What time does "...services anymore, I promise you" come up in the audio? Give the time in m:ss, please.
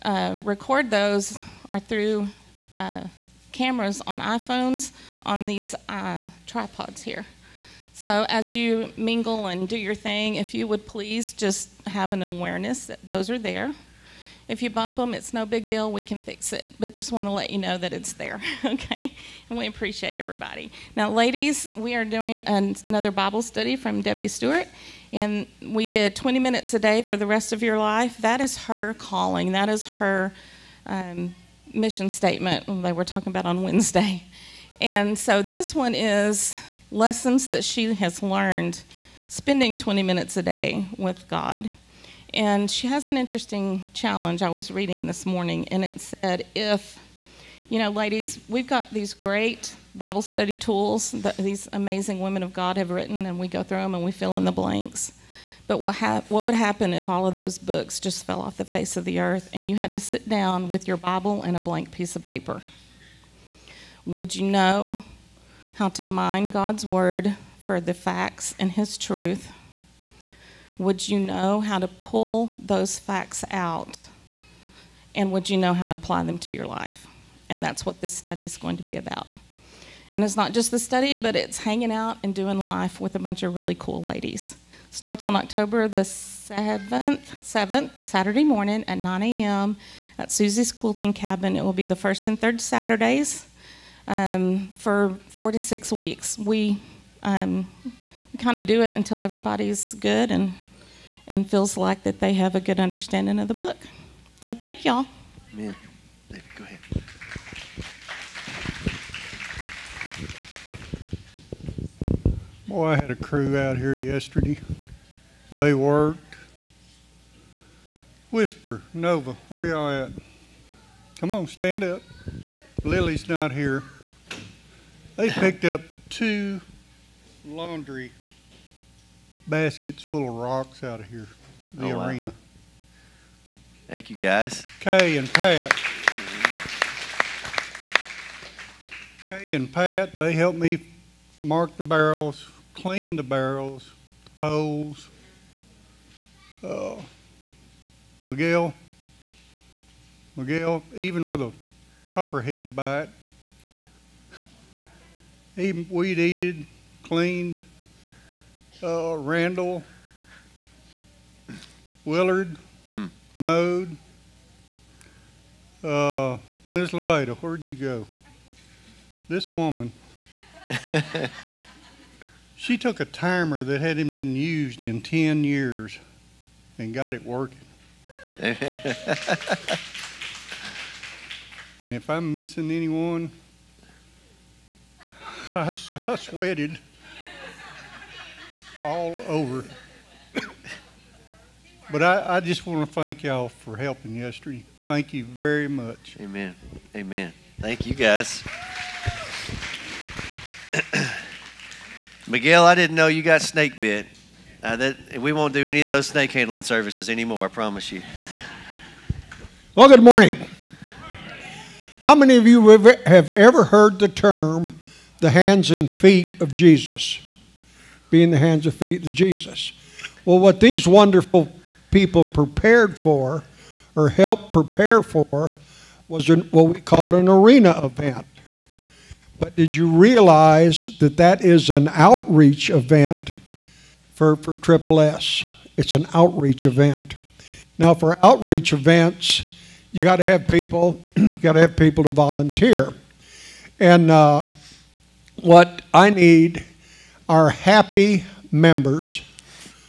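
3:26.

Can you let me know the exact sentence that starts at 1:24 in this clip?
Starts on October the 7th, 7th Saturday morning at 9 a.m.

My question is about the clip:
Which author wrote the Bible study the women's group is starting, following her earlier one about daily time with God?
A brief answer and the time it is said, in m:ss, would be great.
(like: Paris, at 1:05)
Debbie Stewart, at 0:24.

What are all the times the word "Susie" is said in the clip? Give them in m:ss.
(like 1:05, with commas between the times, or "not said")
1:30.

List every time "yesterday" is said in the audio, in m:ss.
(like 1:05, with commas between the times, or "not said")
1:53, 3:14.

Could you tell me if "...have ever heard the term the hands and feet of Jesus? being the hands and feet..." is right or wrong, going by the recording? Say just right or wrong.
right.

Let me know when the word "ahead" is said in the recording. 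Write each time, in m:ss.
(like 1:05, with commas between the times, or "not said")
1:46.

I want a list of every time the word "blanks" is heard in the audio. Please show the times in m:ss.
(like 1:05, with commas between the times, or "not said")
0:54, 1:01.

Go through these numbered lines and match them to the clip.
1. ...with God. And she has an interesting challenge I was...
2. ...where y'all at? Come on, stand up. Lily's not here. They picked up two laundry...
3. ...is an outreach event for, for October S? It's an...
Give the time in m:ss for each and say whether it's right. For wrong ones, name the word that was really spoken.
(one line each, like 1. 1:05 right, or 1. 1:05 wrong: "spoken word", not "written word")
1. 0:40 right
2. 1:59 right
3. 3:51 wrong: "Triple", not "October".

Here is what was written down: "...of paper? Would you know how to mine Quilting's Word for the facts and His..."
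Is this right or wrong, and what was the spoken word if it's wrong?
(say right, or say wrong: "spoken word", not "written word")
wrong: "God", not "Quilting".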